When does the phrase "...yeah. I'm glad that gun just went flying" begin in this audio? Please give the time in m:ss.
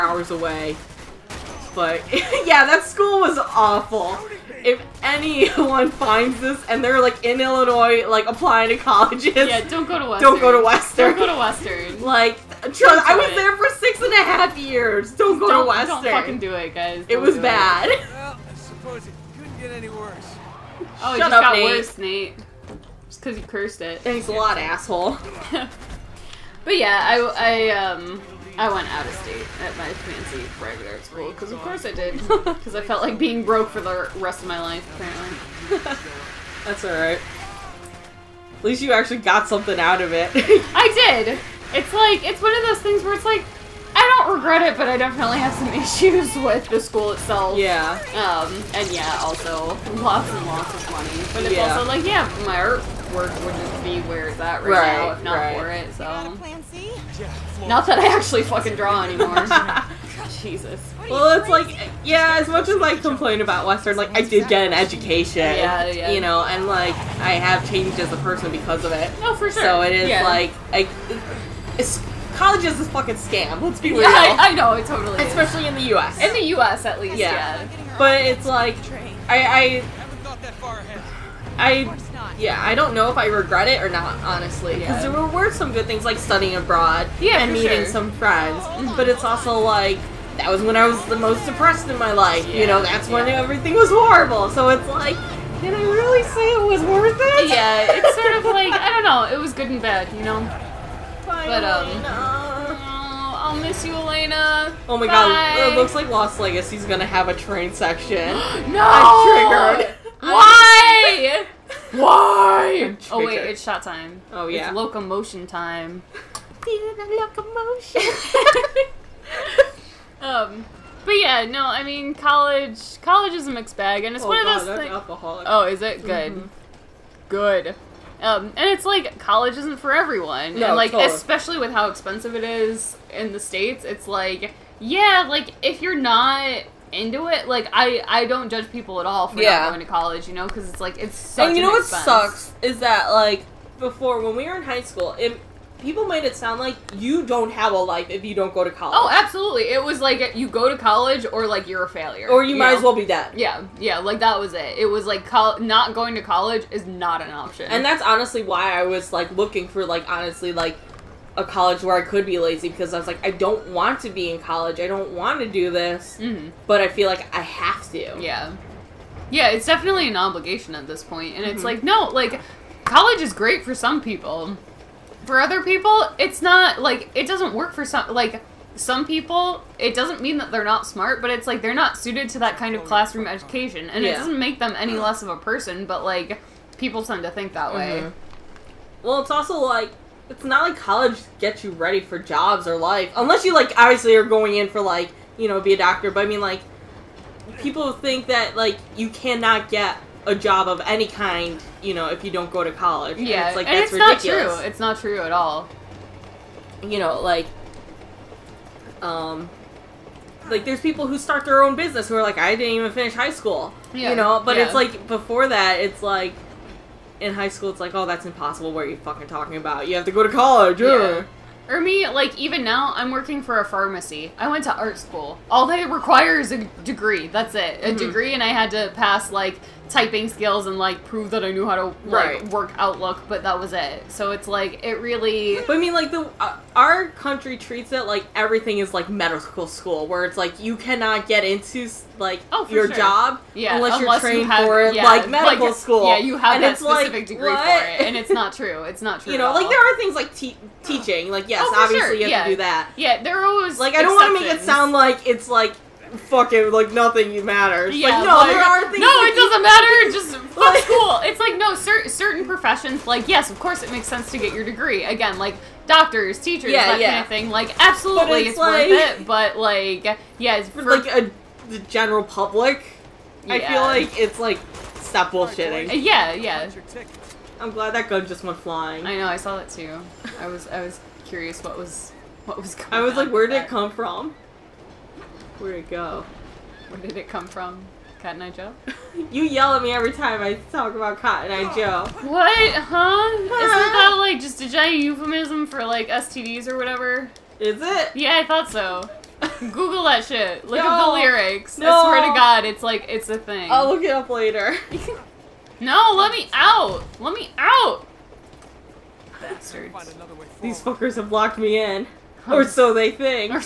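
4:36.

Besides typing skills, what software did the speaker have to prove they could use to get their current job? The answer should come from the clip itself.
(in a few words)
Outlook.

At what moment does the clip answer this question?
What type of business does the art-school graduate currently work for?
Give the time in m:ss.
3:43.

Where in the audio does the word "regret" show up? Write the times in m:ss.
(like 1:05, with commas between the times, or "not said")
0:44, 1:23.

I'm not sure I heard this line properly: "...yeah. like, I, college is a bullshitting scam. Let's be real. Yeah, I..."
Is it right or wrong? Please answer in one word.
wrong.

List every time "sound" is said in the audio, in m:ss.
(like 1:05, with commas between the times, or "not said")
2:26, 4:14.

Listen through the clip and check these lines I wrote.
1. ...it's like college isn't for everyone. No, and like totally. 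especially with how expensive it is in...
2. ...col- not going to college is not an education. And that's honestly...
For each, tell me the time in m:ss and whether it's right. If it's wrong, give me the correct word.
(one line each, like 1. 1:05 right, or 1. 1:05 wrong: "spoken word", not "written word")
1. 2:08 right
2. 2:35 wrong: "option", not "education".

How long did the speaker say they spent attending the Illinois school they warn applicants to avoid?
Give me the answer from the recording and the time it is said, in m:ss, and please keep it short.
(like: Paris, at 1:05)
6 and a half years, at 0:13.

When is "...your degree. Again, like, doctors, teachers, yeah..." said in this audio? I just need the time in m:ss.
4:24.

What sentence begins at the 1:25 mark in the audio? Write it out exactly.
there were some good things like studying abroad yeah, and meeting sure.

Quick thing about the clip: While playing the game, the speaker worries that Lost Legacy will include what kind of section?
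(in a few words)
train section.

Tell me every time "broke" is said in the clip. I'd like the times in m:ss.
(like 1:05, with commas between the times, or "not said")
0:33.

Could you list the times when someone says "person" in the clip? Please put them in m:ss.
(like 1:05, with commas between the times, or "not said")
1:08, 3:05.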